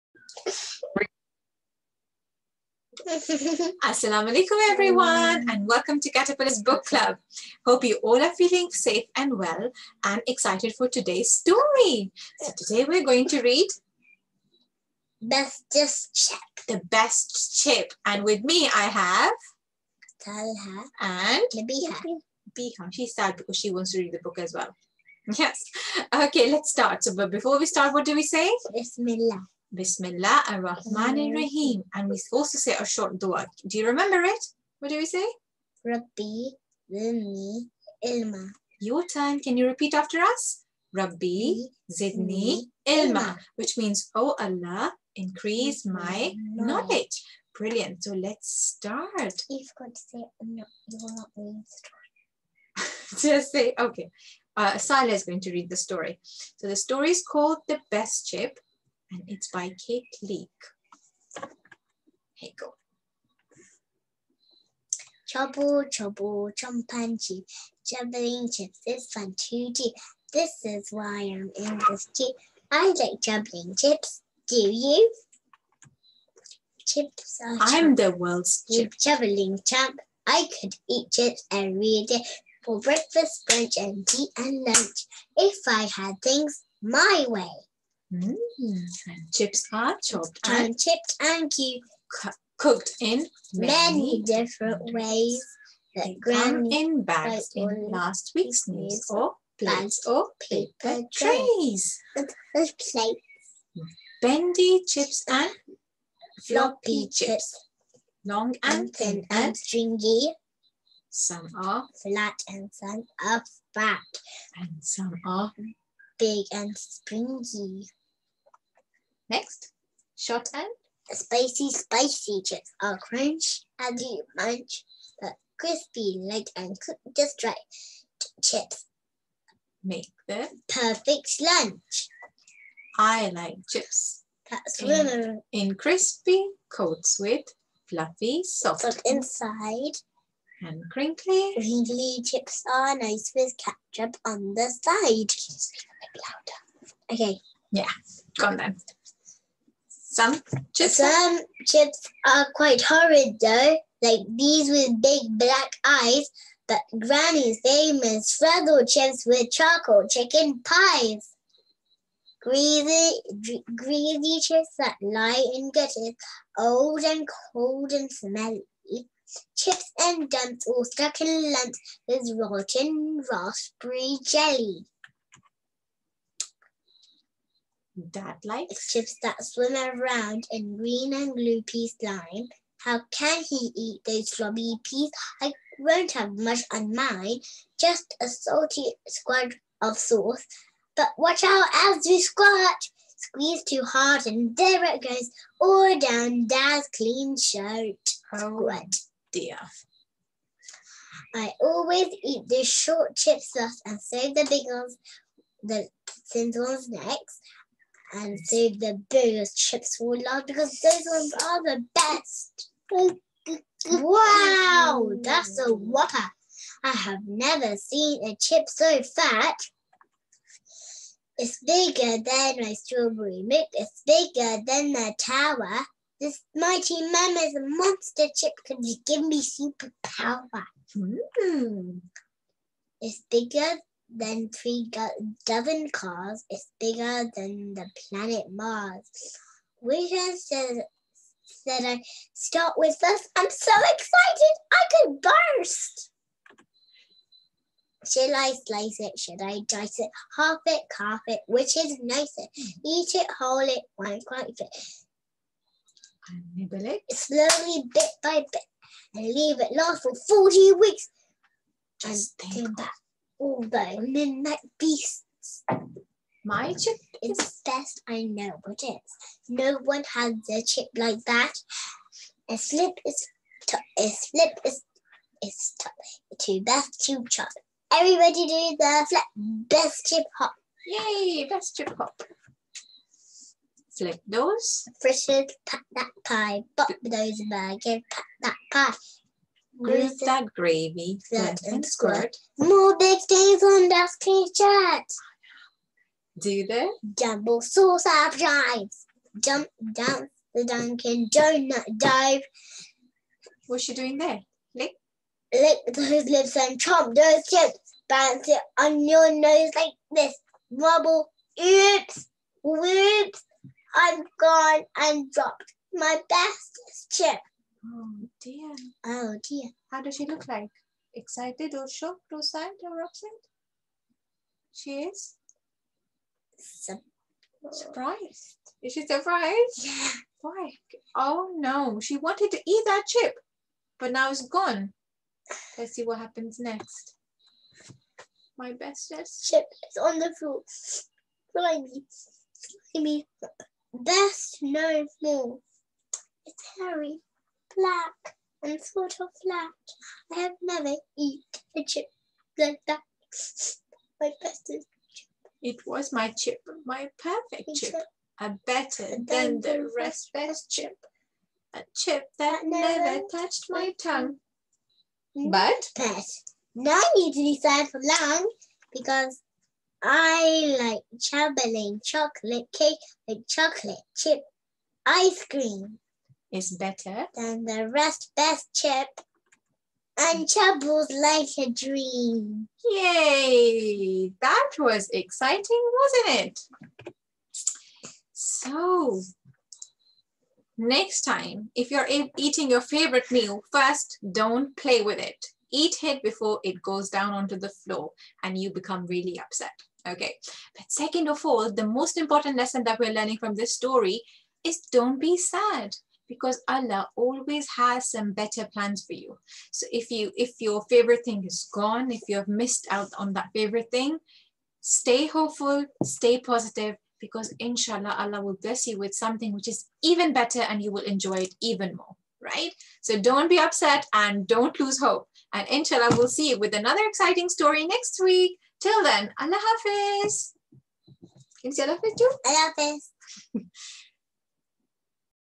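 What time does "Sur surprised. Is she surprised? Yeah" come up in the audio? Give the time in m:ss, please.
5:26.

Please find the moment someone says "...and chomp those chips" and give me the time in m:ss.
5:06.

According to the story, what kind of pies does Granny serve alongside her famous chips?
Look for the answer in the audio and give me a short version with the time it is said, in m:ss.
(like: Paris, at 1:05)
Charcoal chicken pies, at 2:39.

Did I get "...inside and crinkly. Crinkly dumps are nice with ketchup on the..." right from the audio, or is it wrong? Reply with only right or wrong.
wrong.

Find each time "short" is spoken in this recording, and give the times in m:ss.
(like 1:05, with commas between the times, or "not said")
0:32, 2:00, 3:22.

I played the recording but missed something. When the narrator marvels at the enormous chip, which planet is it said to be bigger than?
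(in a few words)
Mars.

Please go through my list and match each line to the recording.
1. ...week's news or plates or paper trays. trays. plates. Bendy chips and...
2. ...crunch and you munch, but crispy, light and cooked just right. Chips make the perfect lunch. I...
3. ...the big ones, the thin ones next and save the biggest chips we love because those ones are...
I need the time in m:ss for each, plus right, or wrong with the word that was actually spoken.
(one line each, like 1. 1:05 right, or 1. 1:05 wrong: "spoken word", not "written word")
1. 1:38 right
2. 2:02 right
3. 3:24 right.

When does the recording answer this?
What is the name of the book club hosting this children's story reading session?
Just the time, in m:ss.
0:06.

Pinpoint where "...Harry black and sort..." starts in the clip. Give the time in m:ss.
5:46.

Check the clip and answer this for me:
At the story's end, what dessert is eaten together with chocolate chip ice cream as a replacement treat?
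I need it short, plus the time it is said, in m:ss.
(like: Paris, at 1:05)
Chocolate cake, at 6:12.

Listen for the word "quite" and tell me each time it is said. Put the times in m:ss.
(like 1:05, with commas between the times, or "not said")
2:32, 4:14.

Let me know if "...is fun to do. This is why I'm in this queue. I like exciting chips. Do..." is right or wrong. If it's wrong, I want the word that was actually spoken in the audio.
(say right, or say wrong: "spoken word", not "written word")
wrong: "juggling", not "exciting".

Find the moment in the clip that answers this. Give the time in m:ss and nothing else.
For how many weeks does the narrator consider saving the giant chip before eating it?
4:20.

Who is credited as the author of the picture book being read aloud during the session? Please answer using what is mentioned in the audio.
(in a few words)
Kate Leake.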